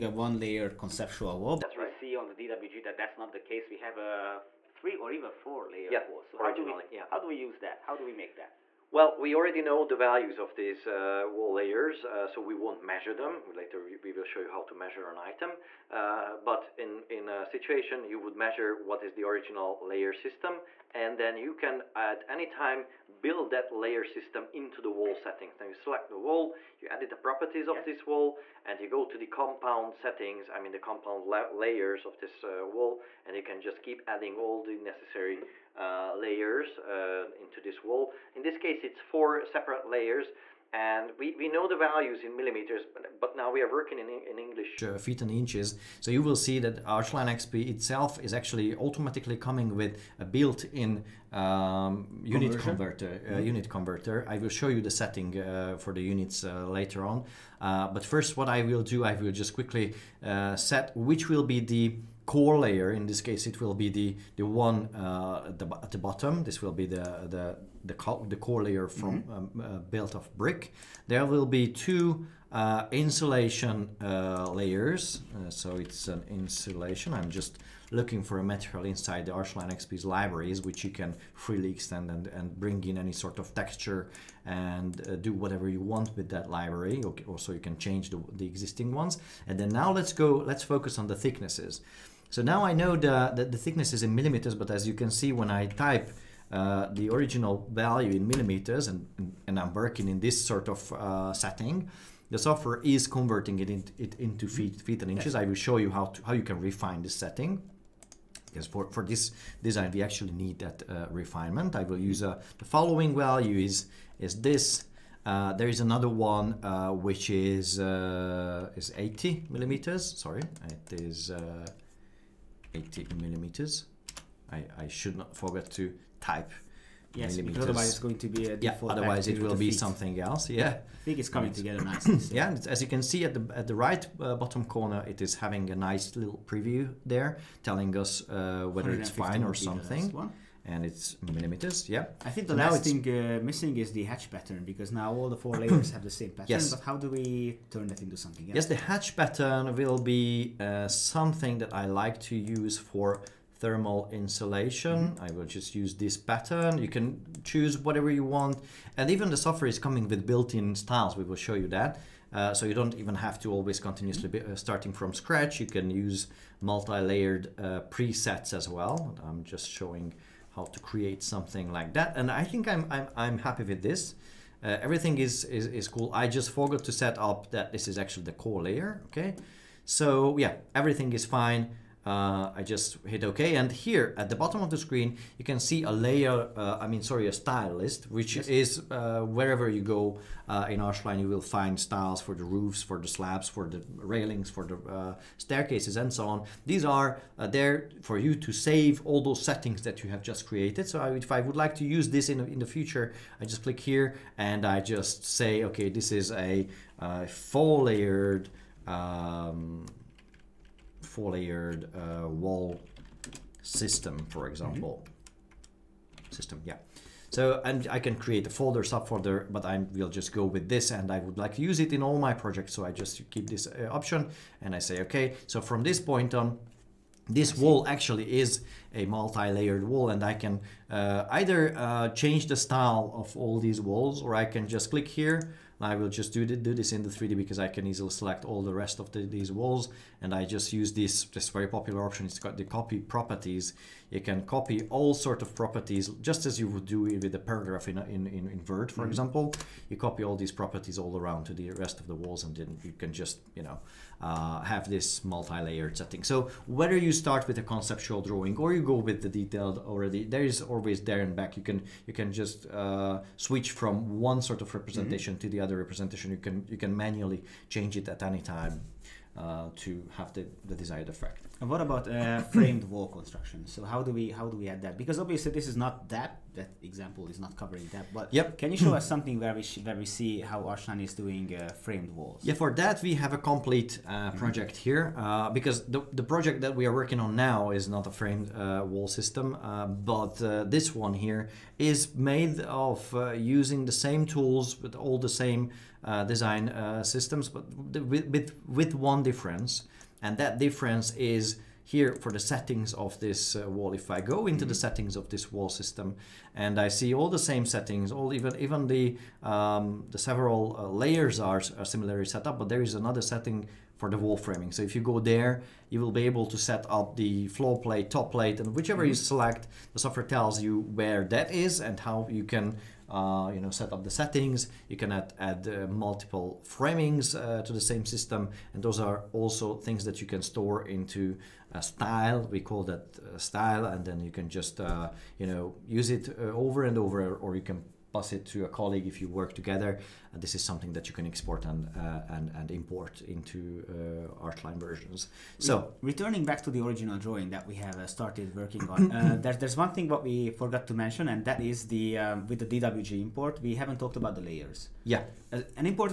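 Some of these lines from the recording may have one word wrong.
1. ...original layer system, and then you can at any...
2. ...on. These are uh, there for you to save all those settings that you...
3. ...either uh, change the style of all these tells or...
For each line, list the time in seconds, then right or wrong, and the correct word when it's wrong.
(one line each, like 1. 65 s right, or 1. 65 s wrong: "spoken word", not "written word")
1. 19 s right
2. 196 s right
3. 231 s wrong: "walls", not "tells".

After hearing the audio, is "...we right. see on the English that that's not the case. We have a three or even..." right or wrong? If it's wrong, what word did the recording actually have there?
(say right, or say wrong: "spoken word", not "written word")
wrong: "DWG", not "English".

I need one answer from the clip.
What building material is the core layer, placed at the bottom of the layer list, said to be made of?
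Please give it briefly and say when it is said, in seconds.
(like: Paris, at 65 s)
Brick, at 70 s.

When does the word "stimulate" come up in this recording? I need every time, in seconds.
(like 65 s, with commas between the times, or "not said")
not said.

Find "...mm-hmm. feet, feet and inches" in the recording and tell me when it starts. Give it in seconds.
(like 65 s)
104 s.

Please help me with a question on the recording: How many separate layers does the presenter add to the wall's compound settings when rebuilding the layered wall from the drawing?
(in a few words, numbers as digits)
4.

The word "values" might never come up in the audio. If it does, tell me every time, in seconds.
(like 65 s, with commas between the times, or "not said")
9 s, 41 s, 97 s, 113 s.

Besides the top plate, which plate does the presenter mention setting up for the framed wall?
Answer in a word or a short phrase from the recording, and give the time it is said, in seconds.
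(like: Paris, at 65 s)
Floor plate, at 317 s.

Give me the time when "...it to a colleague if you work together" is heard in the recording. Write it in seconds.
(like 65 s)
338 s.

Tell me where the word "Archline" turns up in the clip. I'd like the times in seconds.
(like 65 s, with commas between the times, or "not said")
46 s, 79 s, 190 s, 280 s, 344 s.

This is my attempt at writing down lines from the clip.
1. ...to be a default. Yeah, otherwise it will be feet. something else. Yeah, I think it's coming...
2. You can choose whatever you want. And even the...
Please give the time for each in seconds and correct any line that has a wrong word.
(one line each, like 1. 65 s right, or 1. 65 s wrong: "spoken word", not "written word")
1. 128 s right
2. 156 s right.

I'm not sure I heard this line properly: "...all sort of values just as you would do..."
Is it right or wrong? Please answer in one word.
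wrong.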